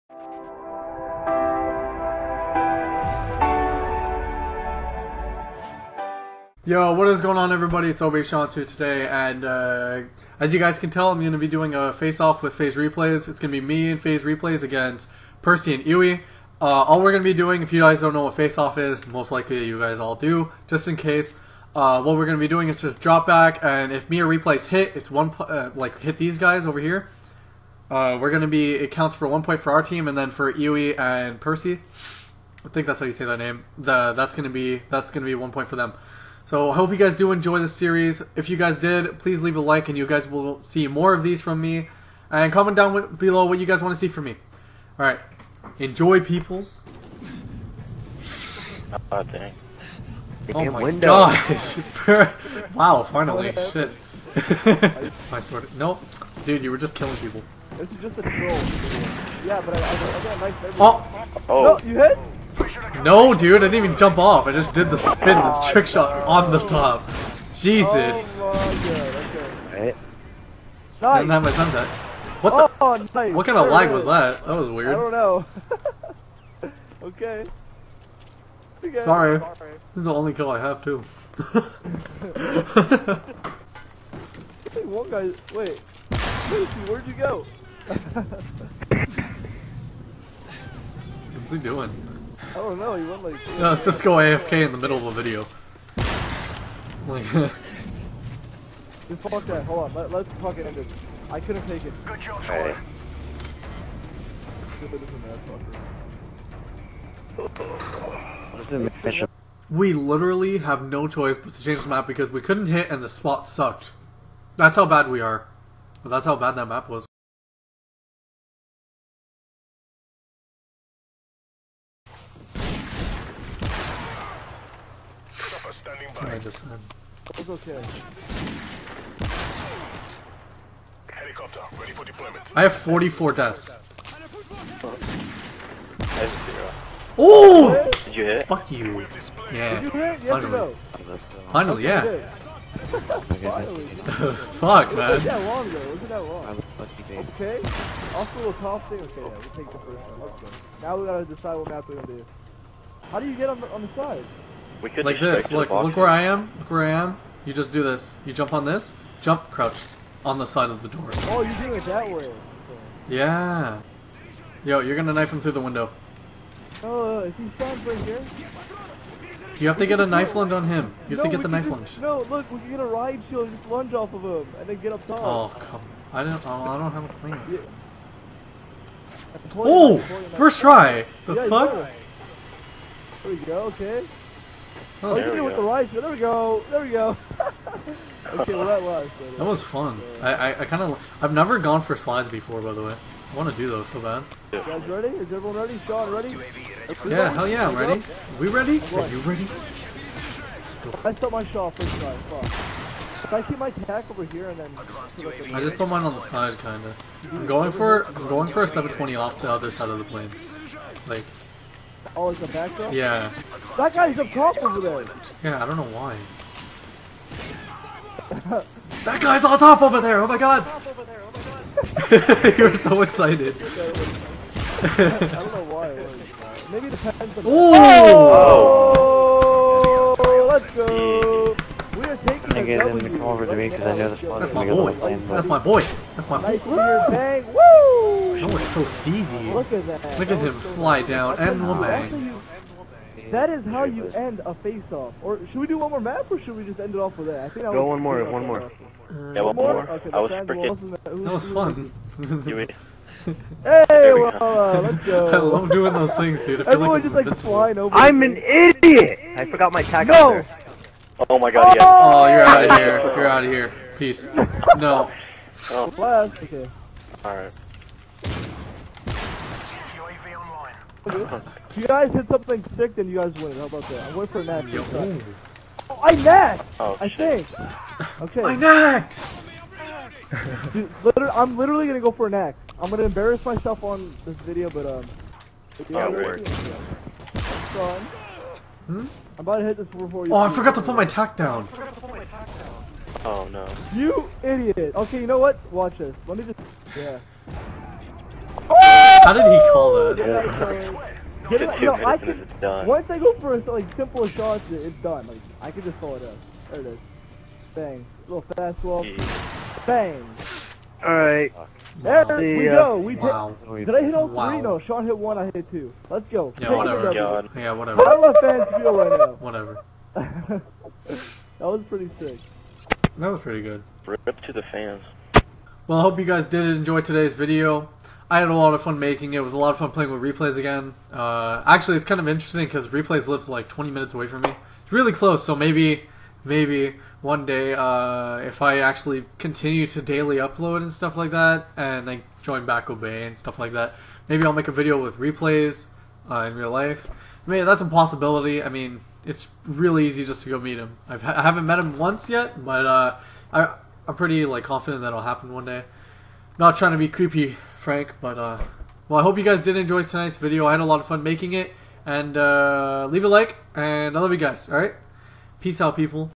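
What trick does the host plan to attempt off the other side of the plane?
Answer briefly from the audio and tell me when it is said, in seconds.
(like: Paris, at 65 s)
720, at 208 s.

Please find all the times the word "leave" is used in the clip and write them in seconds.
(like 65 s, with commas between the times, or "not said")
39 s, 363 s.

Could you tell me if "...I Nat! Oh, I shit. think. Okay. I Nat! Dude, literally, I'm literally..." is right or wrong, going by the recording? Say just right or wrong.
right.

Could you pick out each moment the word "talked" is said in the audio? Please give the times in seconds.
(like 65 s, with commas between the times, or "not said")
not said.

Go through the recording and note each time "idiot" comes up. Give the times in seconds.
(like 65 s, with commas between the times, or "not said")
258 s, 294 s.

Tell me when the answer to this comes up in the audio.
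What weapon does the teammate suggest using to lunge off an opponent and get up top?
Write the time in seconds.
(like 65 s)
172 s.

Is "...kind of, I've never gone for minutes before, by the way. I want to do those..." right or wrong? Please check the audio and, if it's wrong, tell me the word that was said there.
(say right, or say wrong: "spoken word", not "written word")
wrong: "slides", not "minutes".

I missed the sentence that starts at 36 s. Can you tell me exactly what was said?
So I hope you guys do enjoy the series.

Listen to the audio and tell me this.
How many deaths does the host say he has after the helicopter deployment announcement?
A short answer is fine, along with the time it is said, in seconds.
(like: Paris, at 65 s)
44, at 132 s.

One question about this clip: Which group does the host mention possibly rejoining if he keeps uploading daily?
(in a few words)
Obey.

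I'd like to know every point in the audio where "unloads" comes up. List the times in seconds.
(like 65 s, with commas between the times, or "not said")
not said.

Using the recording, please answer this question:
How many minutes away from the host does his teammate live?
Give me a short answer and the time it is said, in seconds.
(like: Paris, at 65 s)
20, at 333 s.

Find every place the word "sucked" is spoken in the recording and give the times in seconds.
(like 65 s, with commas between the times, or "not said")
113 s.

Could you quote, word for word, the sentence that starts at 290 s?
Oh, I forgot to put my tack down.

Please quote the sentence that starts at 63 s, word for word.
No, dude, I didn't even jump off.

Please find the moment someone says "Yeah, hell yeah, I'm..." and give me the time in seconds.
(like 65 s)
197 s.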